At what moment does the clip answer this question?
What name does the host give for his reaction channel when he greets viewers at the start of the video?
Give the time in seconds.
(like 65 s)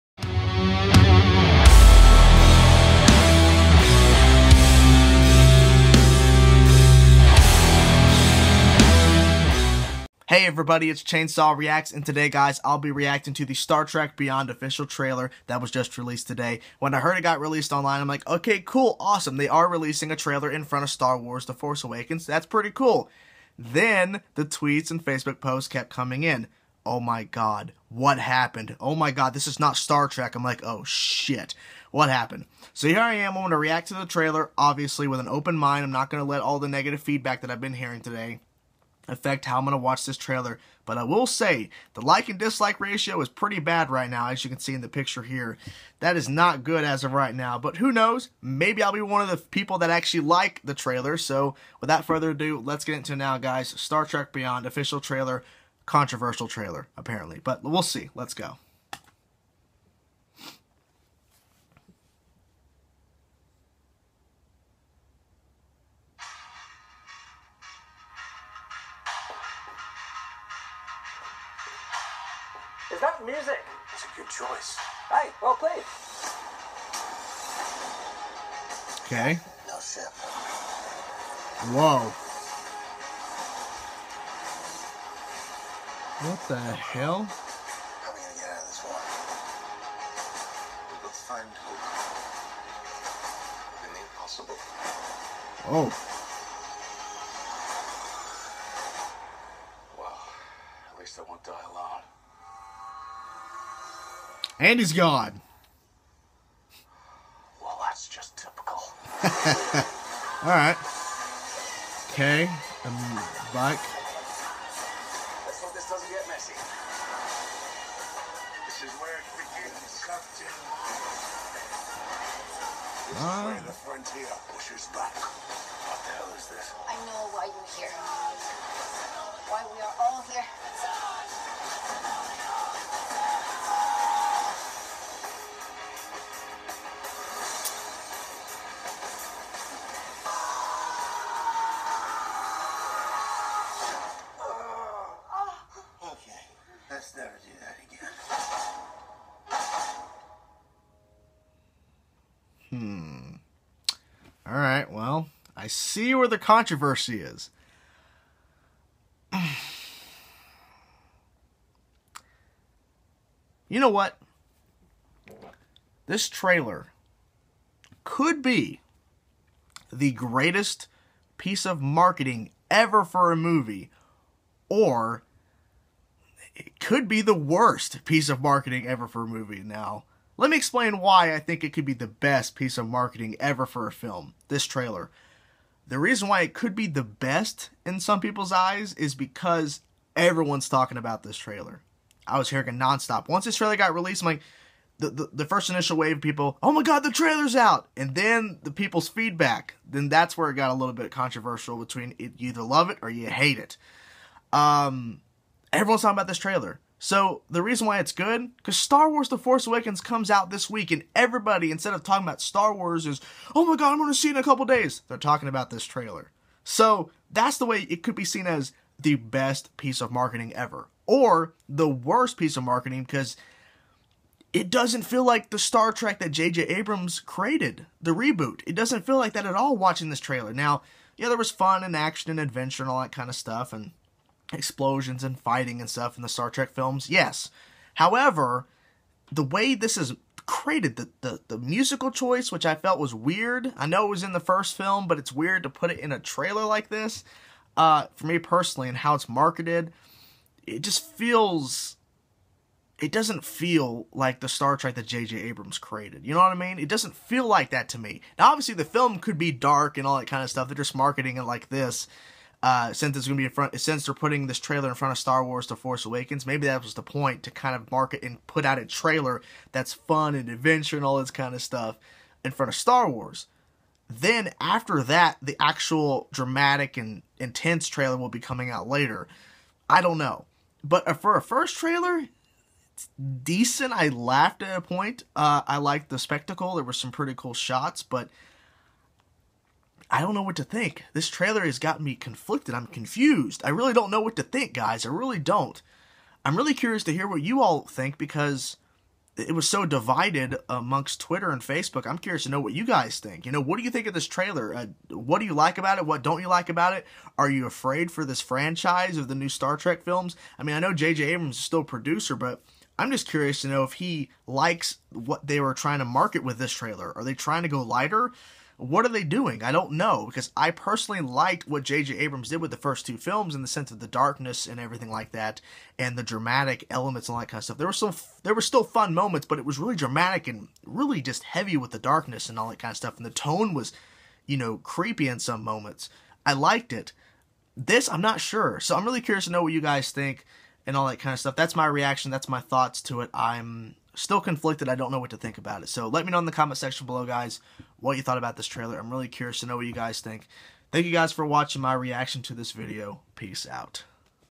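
11 s.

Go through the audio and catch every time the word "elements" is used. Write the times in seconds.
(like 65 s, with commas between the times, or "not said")
326 s.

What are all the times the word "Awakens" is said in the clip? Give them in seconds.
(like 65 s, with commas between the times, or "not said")
21 s, 209 s, 266 s.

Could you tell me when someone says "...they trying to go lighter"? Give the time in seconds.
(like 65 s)
317 s.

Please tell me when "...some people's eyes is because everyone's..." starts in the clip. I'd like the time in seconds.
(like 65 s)
187 s.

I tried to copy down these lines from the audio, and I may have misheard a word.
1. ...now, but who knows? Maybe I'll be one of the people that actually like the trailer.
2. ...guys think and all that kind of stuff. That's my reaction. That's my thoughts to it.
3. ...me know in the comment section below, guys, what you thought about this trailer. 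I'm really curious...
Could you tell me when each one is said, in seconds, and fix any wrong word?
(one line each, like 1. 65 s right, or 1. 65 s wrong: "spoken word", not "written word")
1. 47 s right
2. 339 s right
3. 346 s right.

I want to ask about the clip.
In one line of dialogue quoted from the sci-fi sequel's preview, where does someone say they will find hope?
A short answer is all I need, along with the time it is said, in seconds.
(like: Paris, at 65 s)
in the impossible, at 93 s.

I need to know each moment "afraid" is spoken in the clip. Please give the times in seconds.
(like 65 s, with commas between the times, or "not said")
307 s.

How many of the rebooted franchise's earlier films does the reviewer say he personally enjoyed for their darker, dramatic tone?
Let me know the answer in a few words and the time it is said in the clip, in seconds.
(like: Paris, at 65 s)
2, at 323 s.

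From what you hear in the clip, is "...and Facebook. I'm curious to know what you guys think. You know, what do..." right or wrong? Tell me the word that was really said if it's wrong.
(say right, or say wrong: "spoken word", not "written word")
right.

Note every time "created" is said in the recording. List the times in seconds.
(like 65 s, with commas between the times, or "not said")
227 s, 240 s, 255 s.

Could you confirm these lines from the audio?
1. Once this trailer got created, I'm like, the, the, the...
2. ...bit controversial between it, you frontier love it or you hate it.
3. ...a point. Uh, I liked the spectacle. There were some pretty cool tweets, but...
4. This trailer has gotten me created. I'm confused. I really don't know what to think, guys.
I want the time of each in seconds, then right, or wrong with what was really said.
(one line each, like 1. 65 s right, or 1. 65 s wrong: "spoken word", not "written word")
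1. 193 s wrong: "released", not "created"
2. 200 s wrong: "either", not "frontier"
3. 284 s wrong: "shots", not "tweets"
4. 291 s wrong: "conflicted", not "created".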